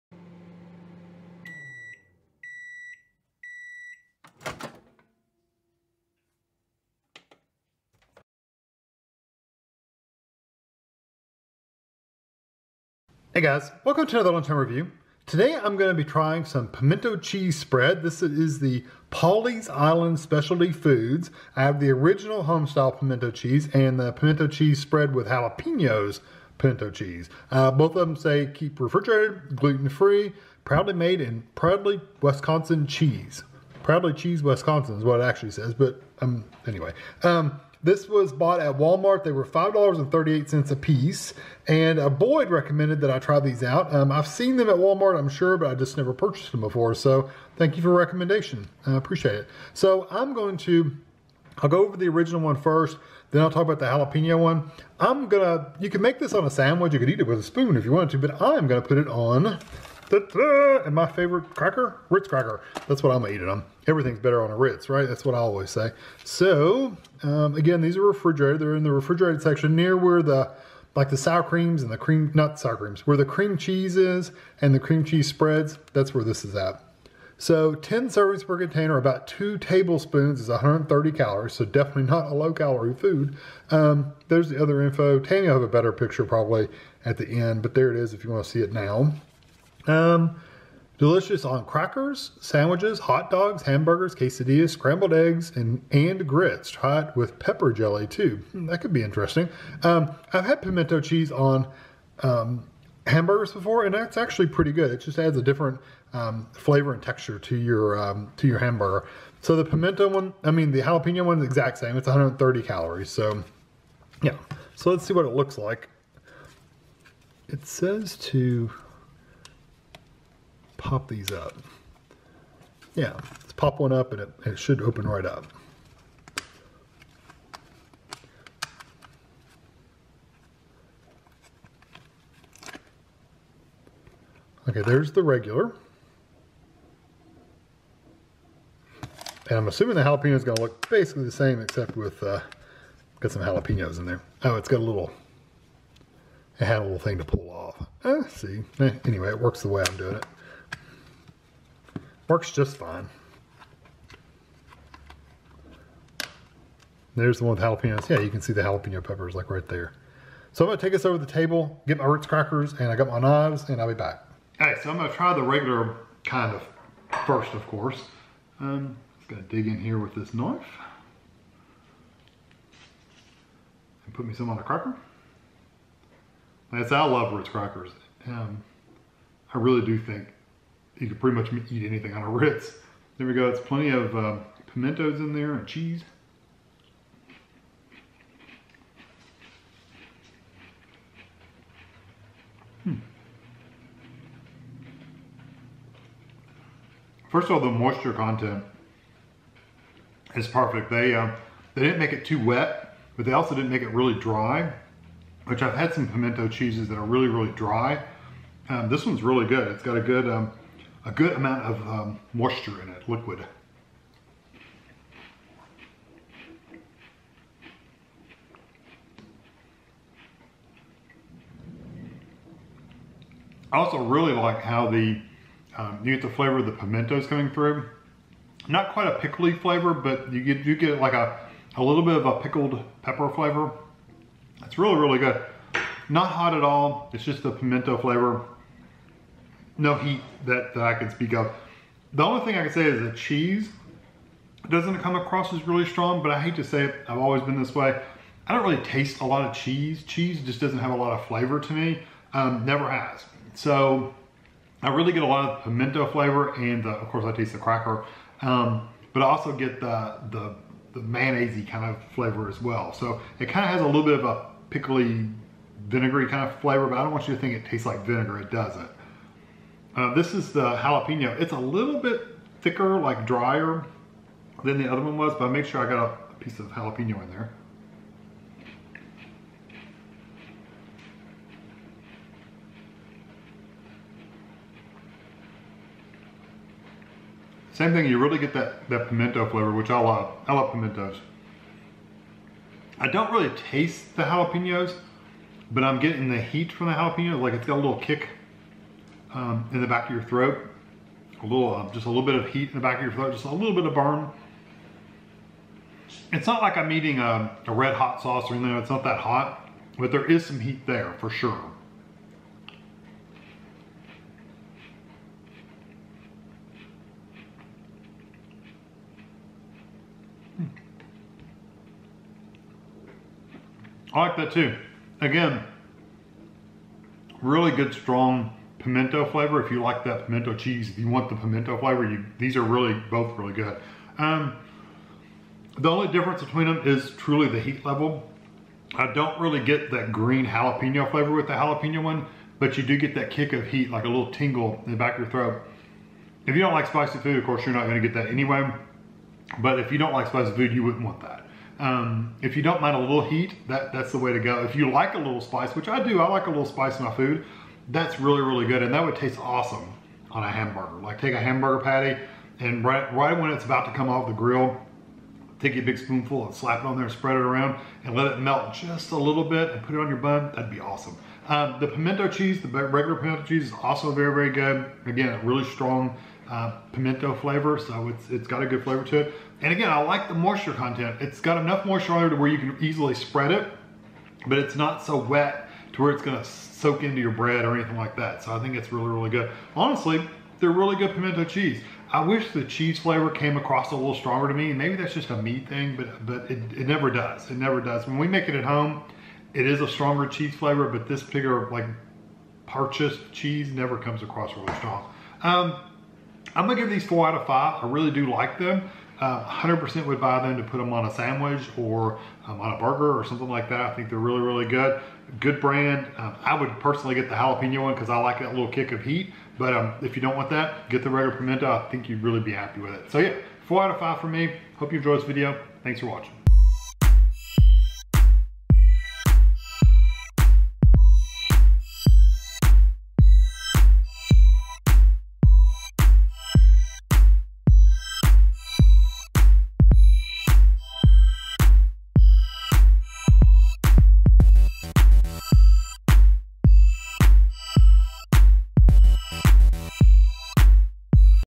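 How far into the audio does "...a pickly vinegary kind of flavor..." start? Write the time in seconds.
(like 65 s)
264 s.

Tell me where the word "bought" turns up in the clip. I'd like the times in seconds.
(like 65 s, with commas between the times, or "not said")
38 s.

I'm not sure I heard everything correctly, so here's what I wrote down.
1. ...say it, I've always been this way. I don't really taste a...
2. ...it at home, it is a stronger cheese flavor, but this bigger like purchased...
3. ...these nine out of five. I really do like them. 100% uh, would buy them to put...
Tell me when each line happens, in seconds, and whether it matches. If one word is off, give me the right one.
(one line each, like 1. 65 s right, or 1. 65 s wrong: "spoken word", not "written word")
1. 246 s right
2. 398 s right
3. 406 s wrong: "four", not "nine".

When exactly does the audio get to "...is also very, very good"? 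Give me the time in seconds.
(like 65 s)
373 s.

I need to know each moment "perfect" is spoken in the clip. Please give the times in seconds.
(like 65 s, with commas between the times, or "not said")
200 s.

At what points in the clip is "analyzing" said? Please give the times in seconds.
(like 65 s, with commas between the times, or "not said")
not said.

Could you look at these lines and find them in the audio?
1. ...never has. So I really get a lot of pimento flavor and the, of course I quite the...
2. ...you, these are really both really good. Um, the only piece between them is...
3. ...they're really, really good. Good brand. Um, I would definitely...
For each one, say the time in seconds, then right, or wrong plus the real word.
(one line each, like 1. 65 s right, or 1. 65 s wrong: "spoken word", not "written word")
1. 252 s wrong: "taste", not "quite"
2. 332 s wrong: "difference", not "piece"
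3. 414 s wrong: "personally", not "definitely".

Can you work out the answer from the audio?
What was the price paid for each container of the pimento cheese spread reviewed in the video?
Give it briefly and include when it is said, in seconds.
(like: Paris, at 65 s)
$5.38, at 39 s.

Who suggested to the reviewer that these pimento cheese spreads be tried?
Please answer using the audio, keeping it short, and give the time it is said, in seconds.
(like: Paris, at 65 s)
Boyd, at 42 s.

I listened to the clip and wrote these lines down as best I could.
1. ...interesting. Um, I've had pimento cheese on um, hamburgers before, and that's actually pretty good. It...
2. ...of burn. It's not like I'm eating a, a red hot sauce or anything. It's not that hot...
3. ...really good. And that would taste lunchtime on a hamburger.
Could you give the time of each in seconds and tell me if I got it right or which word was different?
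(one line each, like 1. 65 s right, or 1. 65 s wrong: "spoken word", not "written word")
1. 99 s right
2. 303 s right
3. 358 s wrong: "awesome", not "lunchtime".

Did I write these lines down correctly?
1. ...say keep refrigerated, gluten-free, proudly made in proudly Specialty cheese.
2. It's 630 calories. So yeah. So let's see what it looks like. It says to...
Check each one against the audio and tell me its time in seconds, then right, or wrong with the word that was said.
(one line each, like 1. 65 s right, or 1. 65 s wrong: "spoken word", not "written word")
1. 28 s wrong: "Wisconsin", not "Specialty"
2. 111 s wrong: "130", not "630".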